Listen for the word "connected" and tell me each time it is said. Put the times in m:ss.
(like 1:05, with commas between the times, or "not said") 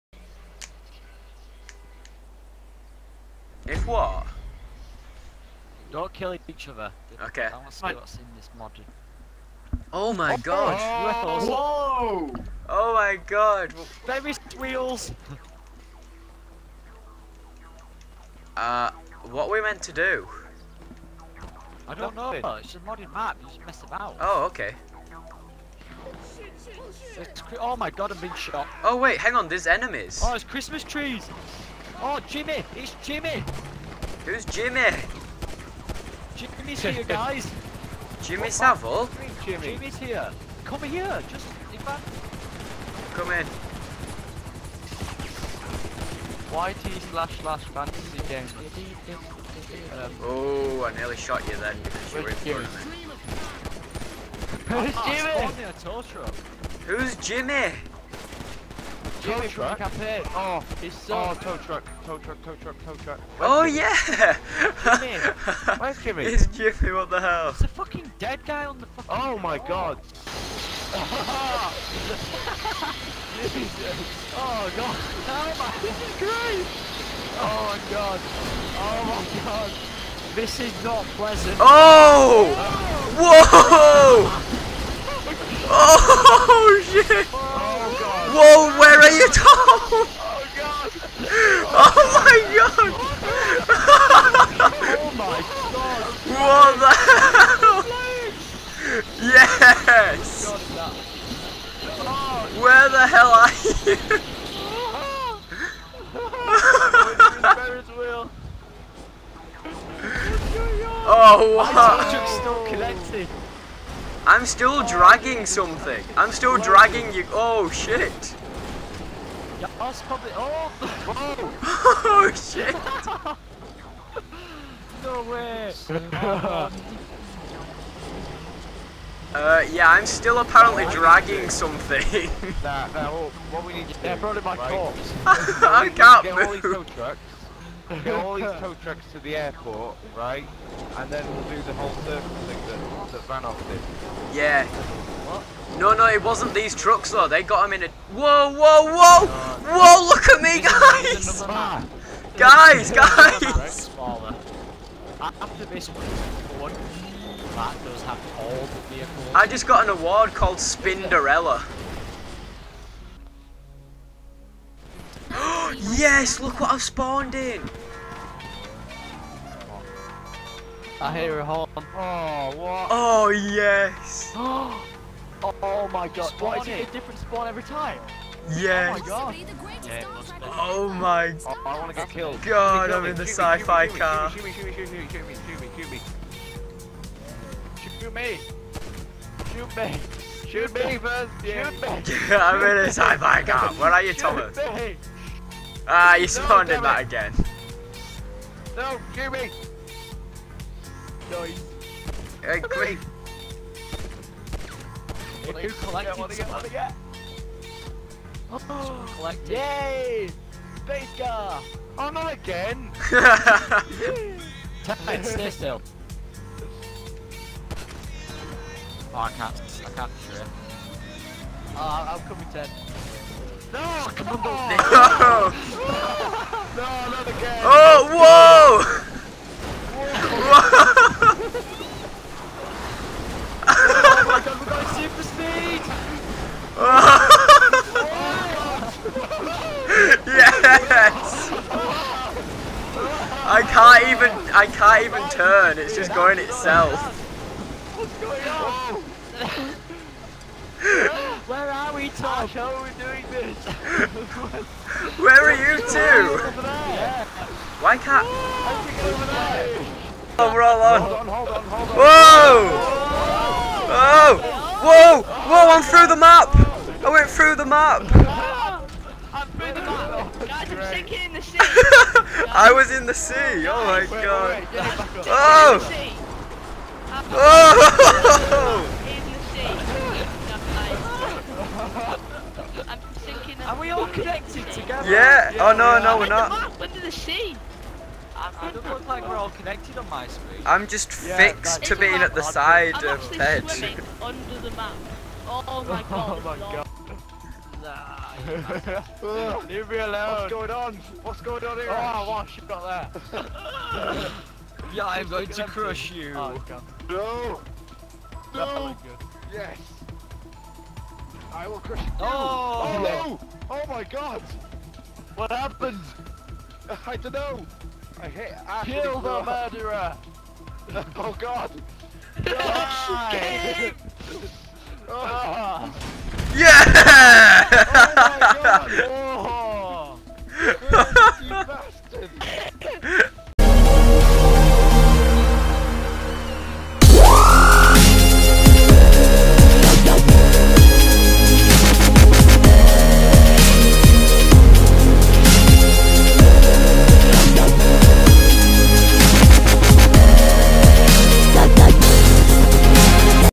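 4:44, 4:49.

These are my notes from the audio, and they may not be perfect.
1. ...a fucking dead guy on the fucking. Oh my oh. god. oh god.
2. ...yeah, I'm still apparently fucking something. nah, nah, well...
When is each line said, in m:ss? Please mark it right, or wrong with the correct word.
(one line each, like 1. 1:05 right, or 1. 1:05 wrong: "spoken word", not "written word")
1. 1:07 right
2. 2:09 wrong: "dragging", not "fucking".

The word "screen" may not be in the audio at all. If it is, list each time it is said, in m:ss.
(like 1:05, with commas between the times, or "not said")
4:50.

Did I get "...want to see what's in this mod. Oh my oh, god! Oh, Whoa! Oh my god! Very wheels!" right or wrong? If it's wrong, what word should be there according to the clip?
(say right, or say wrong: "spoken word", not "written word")
right.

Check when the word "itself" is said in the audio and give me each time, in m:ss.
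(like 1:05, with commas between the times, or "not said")
4:06.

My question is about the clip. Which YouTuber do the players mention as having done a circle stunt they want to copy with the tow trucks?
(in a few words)
Vanoss.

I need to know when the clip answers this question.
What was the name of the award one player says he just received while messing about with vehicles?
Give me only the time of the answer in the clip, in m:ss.
2:40.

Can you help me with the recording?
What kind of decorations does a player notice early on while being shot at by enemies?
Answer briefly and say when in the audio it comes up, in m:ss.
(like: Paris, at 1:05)
Christmas trees, at 0:30.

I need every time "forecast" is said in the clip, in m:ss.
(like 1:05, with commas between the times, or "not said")
not said.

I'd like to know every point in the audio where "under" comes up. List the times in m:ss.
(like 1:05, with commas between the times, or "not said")
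4:46, 4:54.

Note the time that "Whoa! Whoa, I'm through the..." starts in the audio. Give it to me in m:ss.
4:25.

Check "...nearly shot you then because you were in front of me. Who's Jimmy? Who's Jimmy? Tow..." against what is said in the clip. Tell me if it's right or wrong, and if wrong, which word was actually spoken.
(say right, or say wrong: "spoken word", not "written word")
right.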